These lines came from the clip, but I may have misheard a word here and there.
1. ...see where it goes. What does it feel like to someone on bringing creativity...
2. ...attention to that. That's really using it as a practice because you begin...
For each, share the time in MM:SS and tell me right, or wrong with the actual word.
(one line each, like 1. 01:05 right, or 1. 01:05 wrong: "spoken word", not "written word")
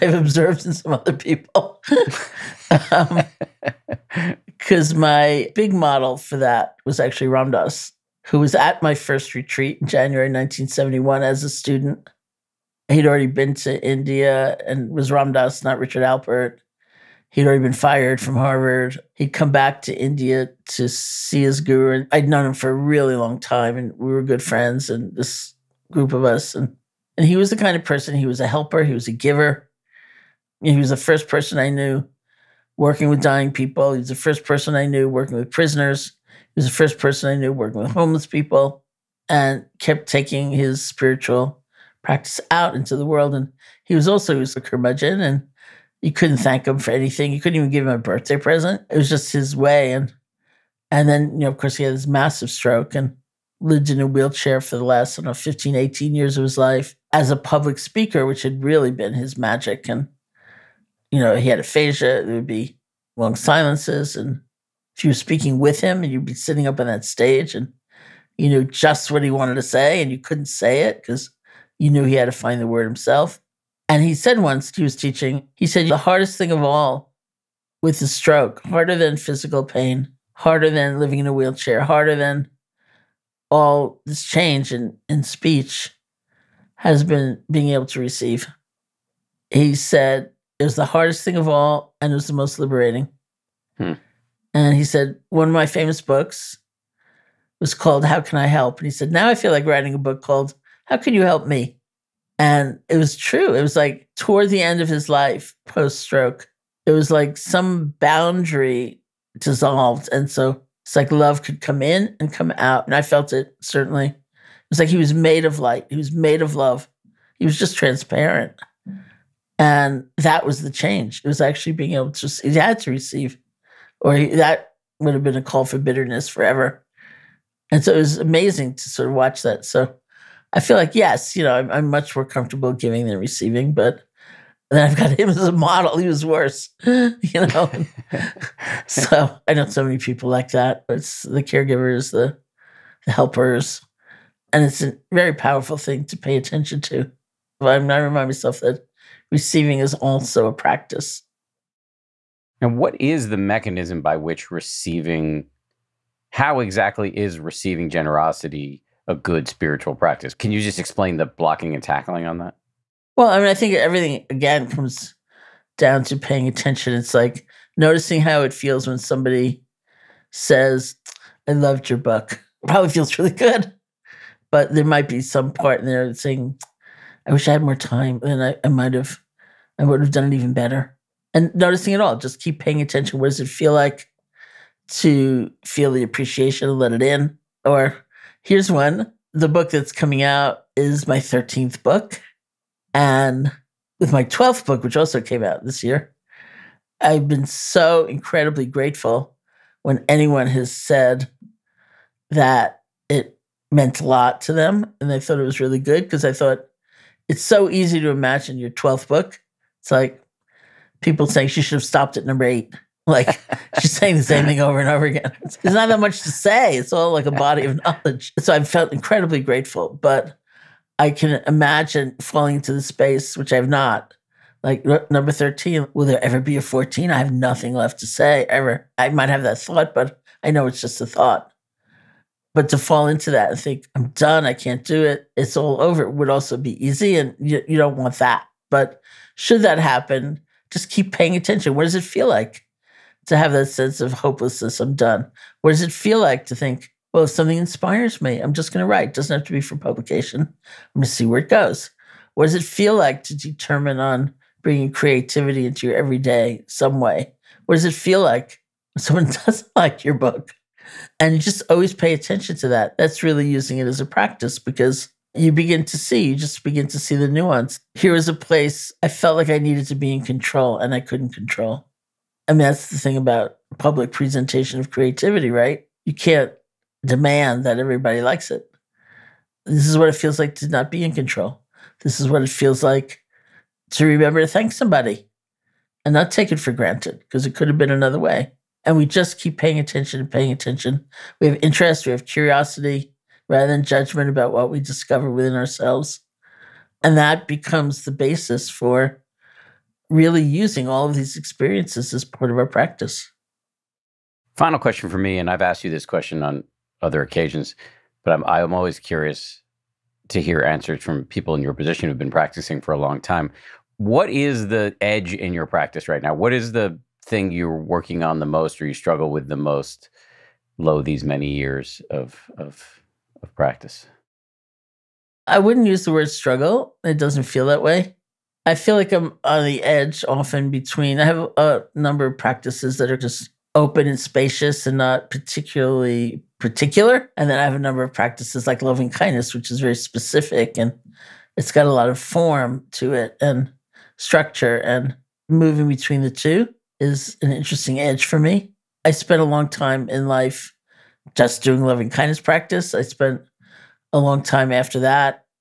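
1. 04:11 wrong: "determine", not "someone"
2. 04:22 right.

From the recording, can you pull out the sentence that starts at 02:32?
And what is the mechanism by which receiving, how exactly is receiving generosity a good spiritual practice?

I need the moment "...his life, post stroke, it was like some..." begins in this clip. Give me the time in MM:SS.
01:44.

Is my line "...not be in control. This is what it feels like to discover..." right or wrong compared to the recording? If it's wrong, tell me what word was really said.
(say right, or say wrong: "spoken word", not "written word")
wrong: "remember", not "discover".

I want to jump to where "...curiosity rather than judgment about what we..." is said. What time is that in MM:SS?
04:52.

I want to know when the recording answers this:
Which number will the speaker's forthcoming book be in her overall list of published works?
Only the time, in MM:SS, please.
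03:11.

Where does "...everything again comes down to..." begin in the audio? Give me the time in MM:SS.
02:43.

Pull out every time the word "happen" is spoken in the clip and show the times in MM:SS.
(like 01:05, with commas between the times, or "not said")
03:59.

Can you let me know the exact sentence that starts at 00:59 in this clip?
And you know, he had aphasia.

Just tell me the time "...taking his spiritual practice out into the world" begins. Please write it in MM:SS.
00:40.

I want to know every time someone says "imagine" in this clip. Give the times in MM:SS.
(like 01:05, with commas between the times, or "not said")
03:28, 03:41.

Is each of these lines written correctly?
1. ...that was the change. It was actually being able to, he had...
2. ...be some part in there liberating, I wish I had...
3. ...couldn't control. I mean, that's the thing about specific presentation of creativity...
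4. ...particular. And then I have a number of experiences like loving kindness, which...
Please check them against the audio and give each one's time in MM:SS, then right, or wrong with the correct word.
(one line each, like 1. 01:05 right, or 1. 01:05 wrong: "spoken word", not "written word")
1. 02:00 right
2. 02:55 wrong: "saying", not "liberating"
3. 04:31 wrong: "public", not "specific"
4. 05:36 wrong: "practices", not "experiences".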